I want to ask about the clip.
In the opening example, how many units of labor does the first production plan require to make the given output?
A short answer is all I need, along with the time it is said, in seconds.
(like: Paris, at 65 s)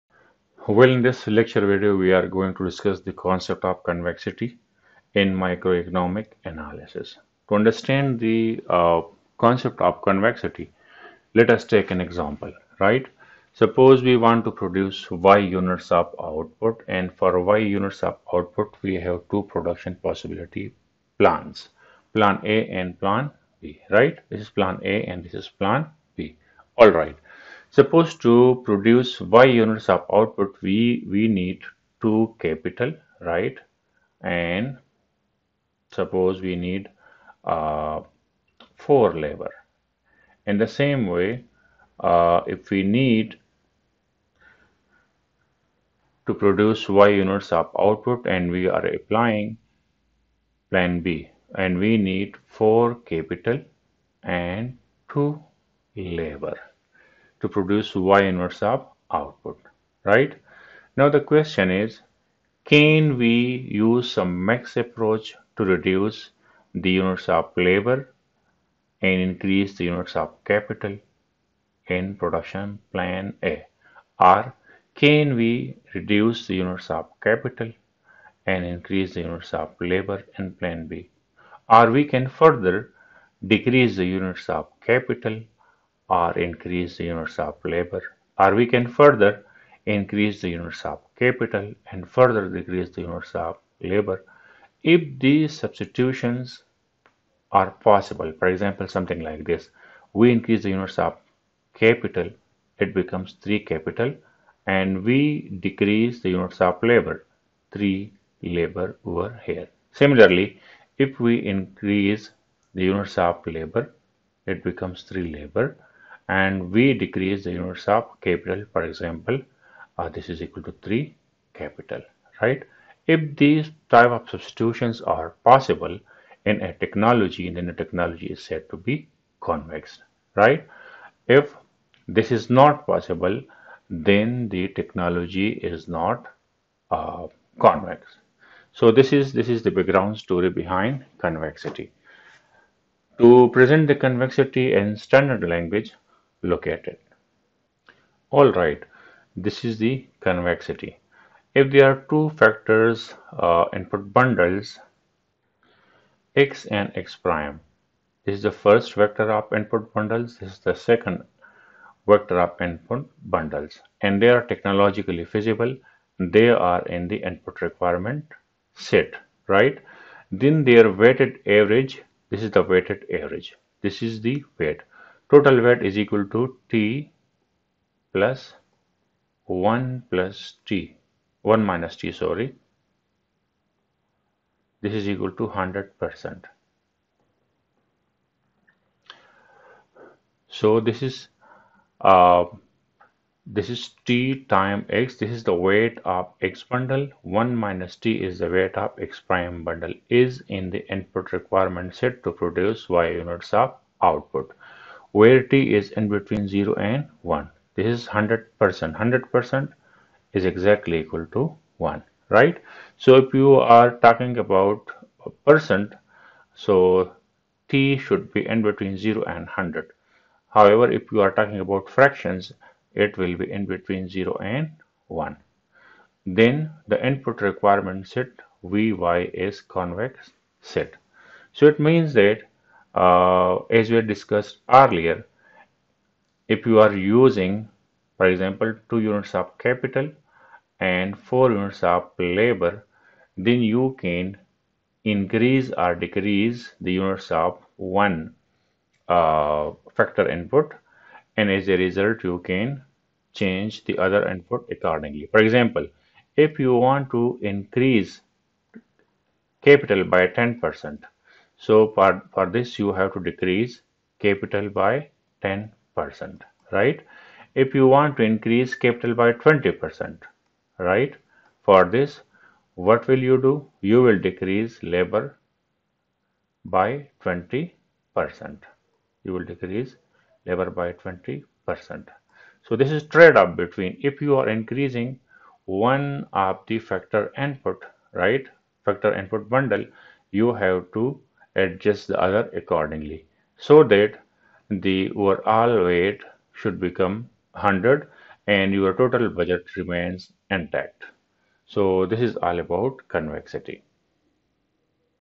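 4, at 38 s.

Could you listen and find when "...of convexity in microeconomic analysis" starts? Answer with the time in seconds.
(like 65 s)
3 s.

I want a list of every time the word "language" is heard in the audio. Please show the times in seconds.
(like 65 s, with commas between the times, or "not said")
145 s.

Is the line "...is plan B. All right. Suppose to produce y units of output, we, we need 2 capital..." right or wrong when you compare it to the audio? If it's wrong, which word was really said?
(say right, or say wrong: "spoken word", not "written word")
right.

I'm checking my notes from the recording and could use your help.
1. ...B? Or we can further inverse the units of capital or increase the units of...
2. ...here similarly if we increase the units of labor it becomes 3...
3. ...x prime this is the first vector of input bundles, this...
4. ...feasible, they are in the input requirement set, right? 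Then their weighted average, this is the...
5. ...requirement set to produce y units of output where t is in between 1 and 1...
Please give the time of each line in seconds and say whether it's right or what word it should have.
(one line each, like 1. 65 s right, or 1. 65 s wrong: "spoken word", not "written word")
1. 80 s wrong: "decrease", not "inverse"
2. 109 s right
3. 156 s right
4. 165 s right
5. 201 s wrong: "0", not "1".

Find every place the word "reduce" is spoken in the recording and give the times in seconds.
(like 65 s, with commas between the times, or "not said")
65 s, 75 s.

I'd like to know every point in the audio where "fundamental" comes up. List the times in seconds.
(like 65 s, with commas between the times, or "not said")
not said.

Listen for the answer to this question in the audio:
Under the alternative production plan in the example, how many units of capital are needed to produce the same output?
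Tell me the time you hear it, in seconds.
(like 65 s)
52 s.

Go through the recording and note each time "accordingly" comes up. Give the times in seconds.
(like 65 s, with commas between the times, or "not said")
254 s, 292 s.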